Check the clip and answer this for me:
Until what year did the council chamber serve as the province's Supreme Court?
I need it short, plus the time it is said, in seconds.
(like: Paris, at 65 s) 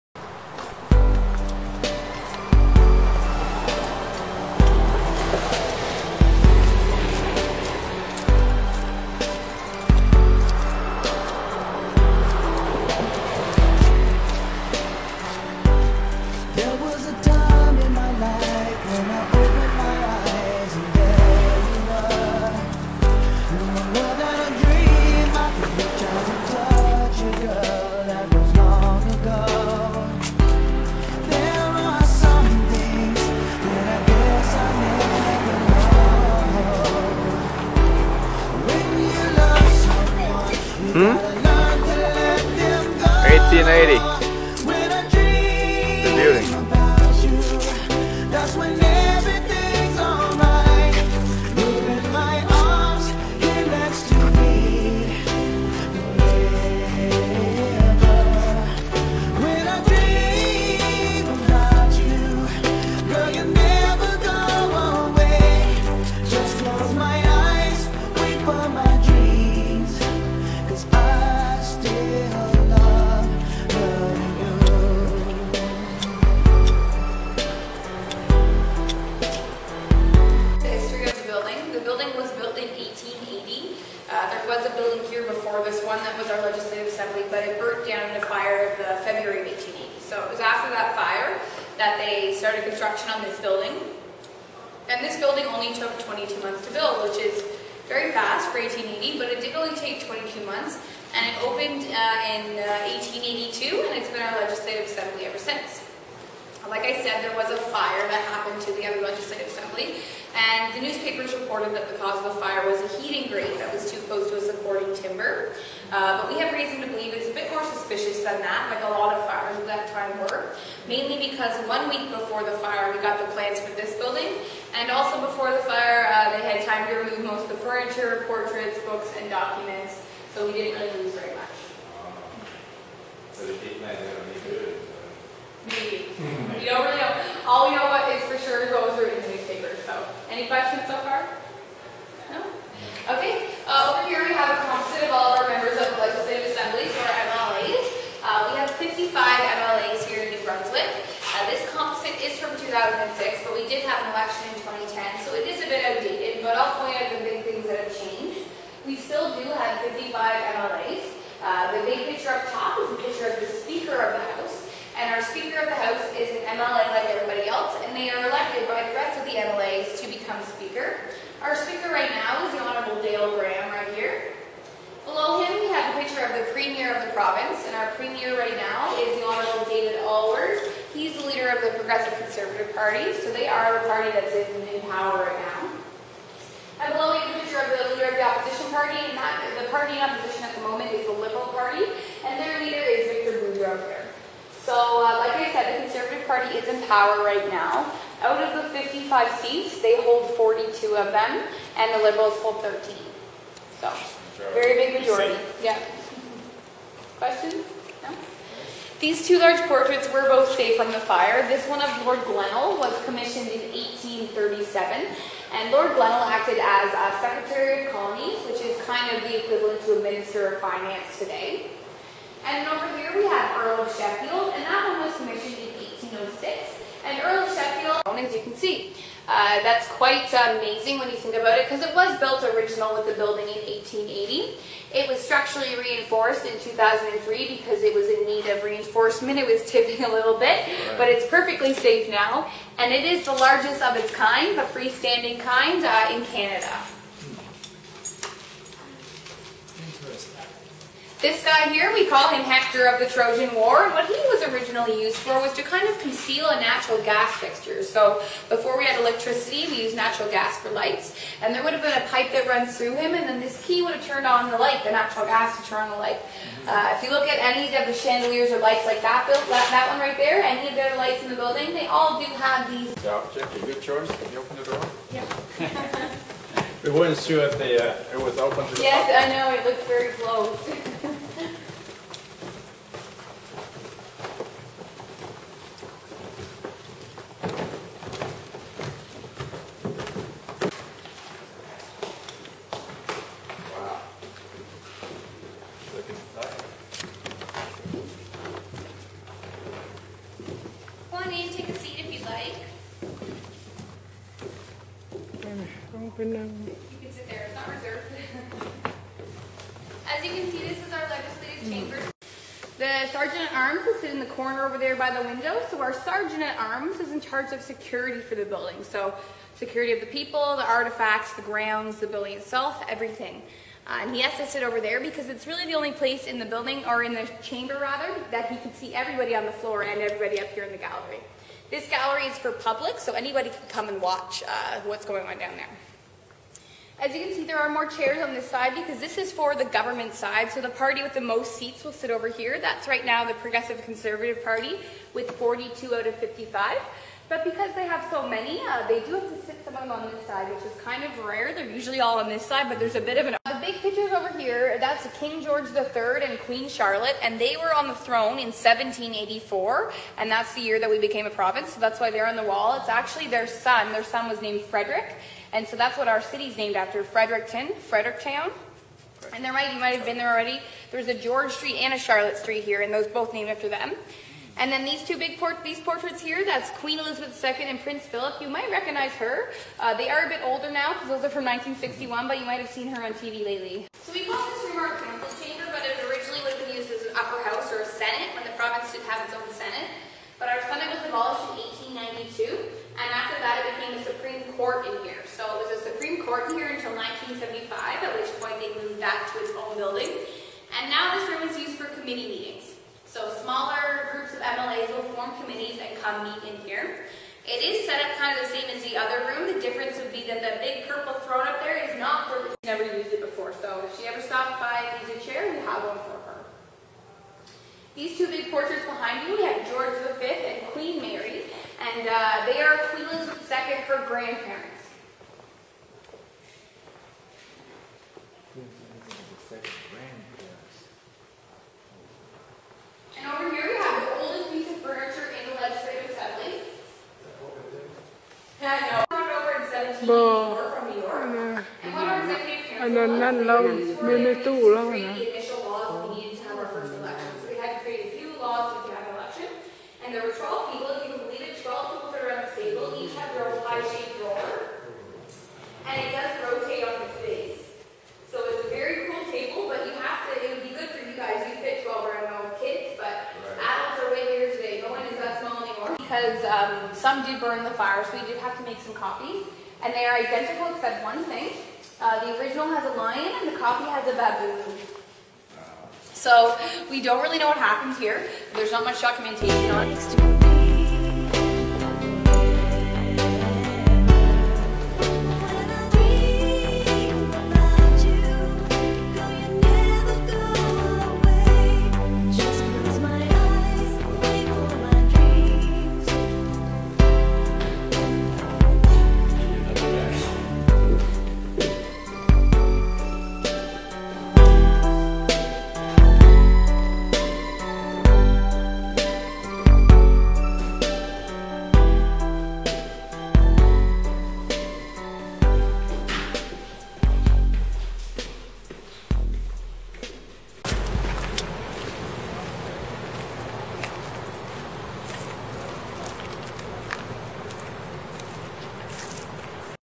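1975, at 396 s.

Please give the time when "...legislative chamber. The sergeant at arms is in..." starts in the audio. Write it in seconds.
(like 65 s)
311 s.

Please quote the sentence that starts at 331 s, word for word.
This gallery is for public, so anybody can come and watch uh, what's going on down there.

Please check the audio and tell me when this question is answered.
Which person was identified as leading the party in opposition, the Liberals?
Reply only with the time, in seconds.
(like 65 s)
193 s.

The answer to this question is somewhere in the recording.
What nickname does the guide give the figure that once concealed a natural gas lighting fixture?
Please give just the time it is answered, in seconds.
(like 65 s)
252 s.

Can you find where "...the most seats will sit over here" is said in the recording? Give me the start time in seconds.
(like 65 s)
341 s.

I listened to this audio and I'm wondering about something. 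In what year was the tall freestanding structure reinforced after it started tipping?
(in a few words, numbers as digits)
2003.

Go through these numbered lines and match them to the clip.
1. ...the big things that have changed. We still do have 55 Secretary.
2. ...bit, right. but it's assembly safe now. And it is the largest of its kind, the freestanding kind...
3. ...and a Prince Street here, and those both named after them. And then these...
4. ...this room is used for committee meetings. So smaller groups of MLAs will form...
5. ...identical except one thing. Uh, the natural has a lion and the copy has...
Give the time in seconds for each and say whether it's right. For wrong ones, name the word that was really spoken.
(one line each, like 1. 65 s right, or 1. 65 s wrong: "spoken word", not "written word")
1. 157 s wrong: "MLAs", not "Secretary"
2. 240 s wrong: "perfectly", not "assembly"
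3. 371 s wrong: "Charlotte", not "Prince"
4. 401 s right
5. 470 s wrong: "original", not "natural".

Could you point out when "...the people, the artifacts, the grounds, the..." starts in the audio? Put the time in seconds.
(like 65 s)
319 s.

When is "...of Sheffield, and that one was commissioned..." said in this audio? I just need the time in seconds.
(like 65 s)
223 s.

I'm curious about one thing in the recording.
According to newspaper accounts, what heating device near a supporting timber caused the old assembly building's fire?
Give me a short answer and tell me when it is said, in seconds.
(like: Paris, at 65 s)
heating grate, at 113 s.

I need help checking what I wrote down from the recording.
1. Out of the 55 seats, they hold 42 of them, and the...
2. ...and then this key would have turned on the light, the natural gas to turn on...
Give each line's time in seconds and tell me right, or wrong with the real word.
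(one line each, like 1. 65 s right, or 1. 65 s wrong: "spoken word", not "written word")
1. 198 s right
2. 263 s right.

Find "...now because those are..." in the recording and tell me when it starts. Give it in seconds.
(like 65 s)
380 s.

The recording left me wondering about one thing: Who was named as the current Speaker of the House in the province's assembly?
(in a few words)
Dale Graham.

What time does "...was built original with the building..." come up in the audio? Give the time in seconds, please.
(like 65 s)
231 s.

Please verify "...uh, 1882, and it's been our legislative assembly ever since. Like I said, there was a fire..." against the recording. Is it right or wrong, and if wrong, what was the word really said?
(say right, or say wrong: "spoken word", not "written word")
right.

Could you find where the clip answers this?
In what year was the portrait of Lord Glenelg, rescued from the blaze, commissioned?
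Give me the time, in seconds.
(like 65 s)
213 s.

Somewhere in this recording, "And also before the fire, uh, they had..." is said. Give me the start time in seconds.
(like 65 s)
124 s.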